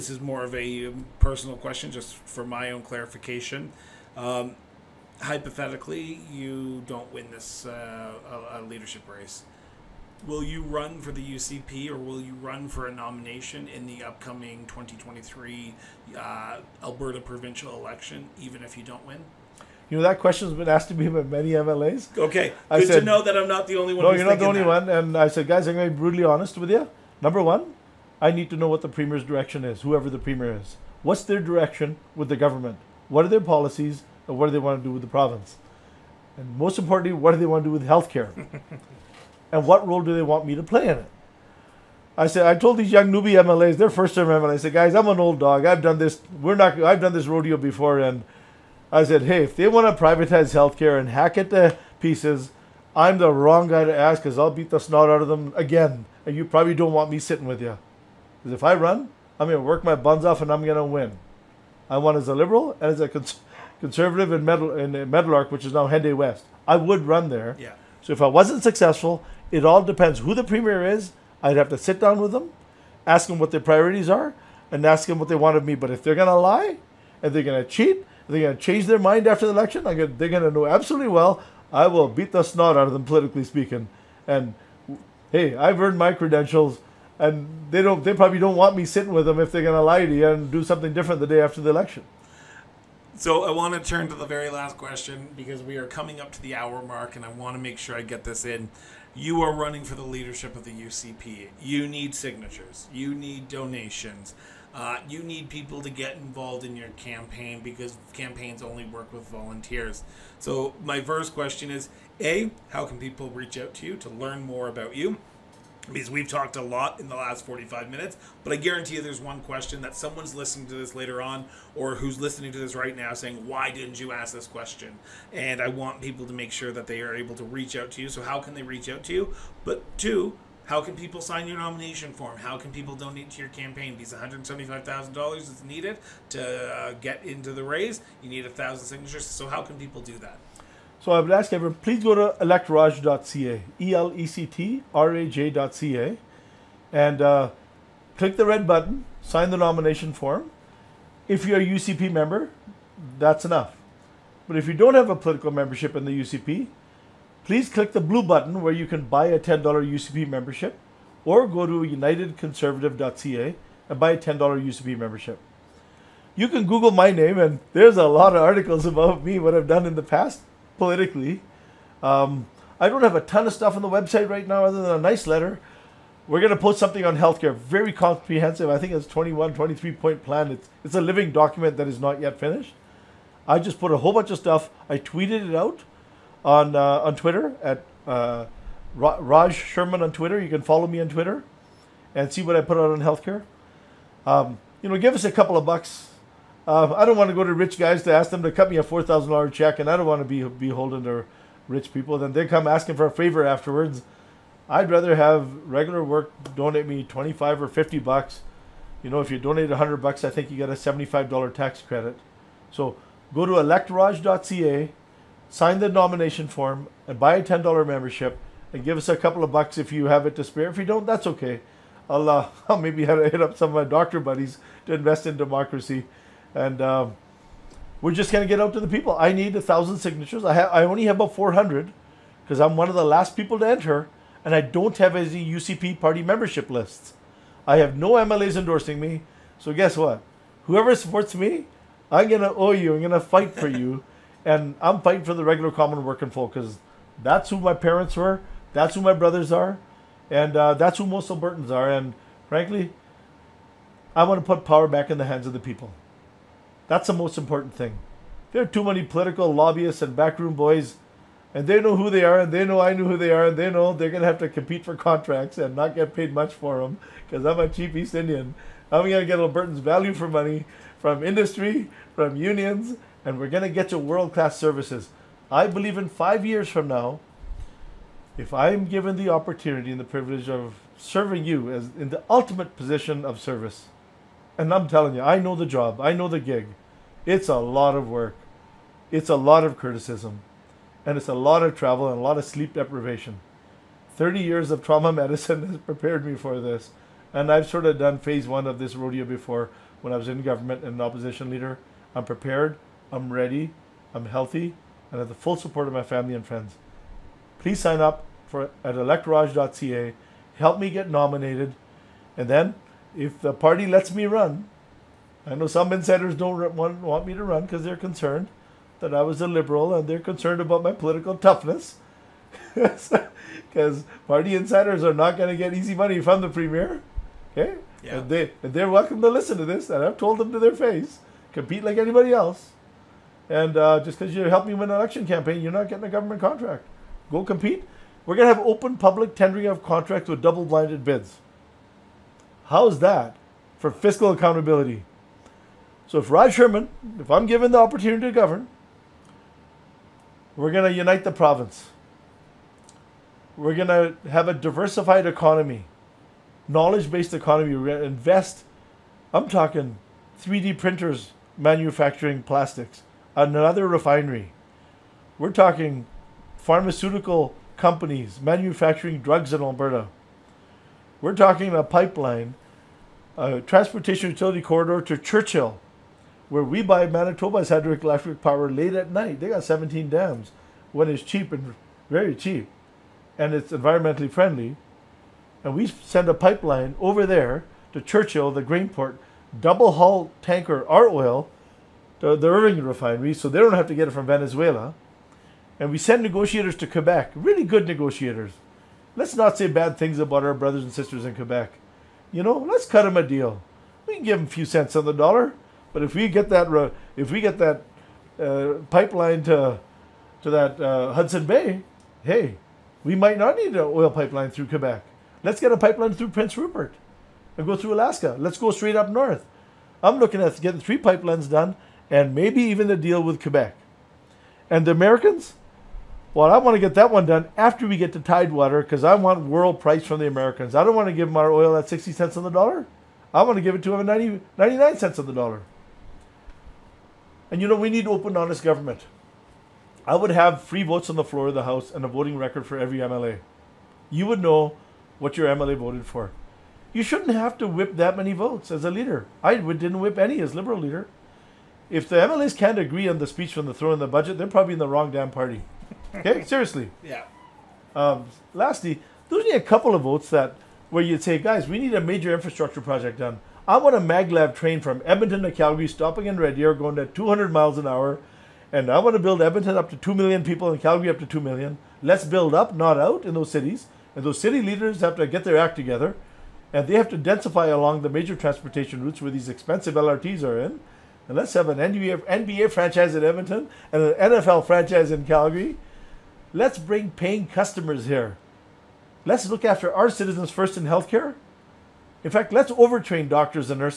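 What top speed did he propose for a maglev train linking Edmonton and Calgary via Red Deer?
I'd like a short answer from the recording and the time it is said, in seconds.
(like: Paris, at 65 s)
200 miles an hour, at 467 s.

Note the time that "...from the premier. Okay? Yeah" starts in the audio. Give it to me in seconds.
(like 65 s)
326 s.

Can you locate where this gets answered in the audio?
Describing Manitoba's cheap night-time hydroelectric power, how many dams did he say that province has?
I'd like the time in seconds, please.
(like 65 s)
379 s.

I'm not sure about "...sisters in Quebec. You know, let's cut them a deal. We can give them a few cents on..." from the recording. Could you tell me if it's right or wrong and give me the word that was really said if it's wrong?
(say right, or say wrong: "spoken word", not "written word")
right.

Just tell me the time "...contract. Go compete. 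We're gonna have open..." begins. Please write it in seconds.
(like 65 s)
336 s.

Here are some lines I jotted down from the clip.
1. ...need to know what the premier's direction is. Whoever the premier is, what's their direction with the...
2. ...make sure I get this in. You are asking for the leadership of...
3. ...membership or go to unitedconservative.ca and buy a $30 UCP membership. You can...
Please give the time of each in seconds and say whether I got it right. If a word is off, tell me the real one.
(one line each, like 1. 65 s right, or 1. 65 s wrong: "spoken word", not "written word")
1. 28 s right
2. 97 s wrong: "running", not "asking"
3. 160 s wrong: "10", not "30".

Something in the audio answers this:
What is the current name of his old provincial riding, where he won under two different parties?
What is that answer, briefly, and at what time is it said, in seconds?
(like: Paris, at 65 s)
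Henday West, at 65 s.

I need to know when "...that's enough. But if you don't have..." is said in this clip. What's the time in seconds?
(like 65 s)
153 s.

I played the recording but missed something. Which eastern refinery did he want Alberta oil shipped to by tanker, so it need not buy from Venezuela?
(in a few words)
Irving refinery.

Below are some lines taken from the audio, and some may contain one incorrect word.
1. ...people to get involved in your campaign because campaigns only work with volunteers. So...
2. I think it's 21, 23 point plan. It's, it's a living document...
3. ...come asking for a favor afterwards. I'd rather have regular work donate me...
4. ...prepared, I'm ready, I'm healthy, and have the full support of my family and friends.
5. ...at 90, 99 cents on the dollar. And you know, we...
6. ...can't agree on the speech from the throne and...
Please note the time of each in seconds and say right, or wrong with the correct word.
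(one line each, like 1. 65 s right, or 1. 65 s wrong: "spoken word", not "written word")
1. 105 s right
2. 178 s right
3. 202 s right
4. 302 s right
5. 433 s right
6. 452 s right.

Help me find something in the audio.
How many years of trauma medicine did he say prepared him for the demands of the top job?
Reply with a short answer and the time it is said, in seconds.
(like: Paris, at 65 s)
30 years, at 294 s.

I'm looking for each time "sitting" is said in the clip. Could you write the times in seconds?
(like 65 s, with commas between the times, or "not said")
57 s, 88 s.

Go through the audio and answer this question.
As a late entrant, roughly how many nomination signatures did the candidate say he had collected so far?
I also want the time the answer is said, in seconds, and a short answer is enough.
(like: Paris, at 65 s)
400, at 231 s.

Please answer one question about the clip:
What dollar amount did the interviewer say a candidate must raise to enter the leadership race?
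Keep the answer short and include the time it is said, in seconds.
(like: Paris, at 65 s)
$175,000, at 134 s.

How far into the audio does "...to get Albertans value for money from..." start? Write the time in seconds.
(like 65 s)
269 s.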